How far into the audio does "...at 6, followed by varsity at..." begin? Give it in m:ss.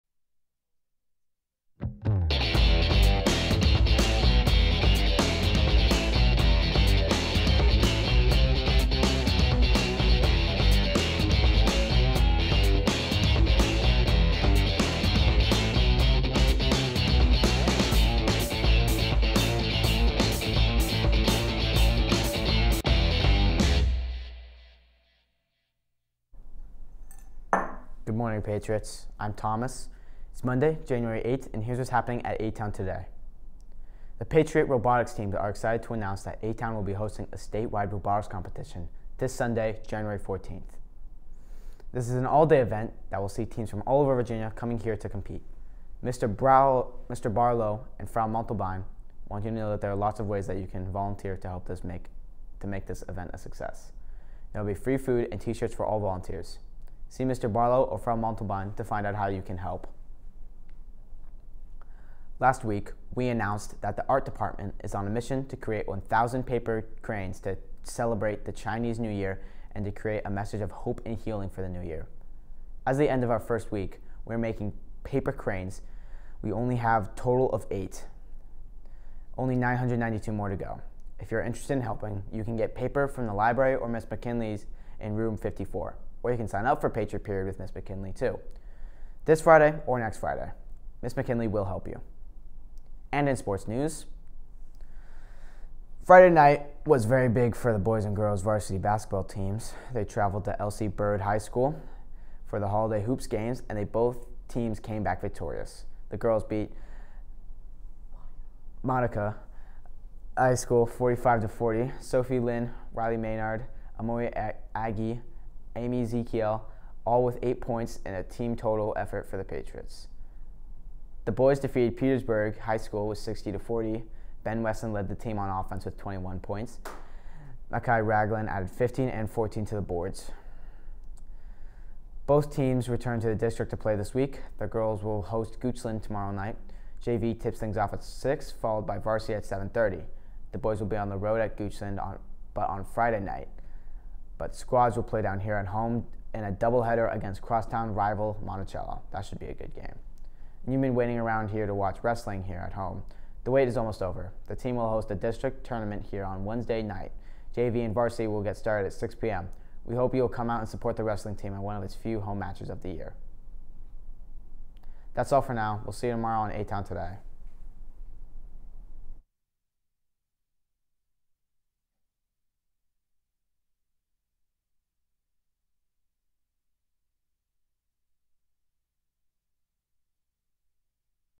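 2:17.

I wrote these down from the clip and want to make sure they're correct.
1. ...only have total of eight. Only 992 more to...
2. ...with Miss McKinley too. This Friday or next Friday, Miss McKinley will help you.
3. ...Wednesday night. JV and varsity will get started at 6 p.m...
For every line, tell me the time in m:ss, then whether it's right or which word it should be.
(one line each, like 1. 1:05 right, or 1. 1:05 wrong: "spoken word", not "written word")
1. 1:16 right
2. 1:27 right
3. 2:36 right.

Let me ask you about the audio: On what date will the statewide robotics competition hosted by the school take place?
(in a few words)
Sunday, January 14th.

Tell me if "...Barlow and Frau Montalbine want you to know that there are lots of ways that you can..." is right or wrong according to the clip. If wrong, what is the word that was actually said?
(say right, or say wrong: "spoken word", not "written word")
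right.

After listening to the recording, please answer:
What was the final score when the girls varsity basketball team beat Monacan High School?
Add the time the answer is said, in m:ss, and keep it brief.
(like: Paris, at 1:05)
45 to 40, at 1:50.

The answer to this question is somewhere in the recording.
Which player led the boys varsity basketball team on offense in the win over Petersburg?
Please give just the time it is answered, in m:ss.
2:04.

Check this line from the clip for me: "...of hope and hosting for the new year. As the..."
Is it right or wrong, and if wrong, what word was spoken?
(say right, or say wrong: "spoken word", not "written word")
wrong: "healing", not "hosting".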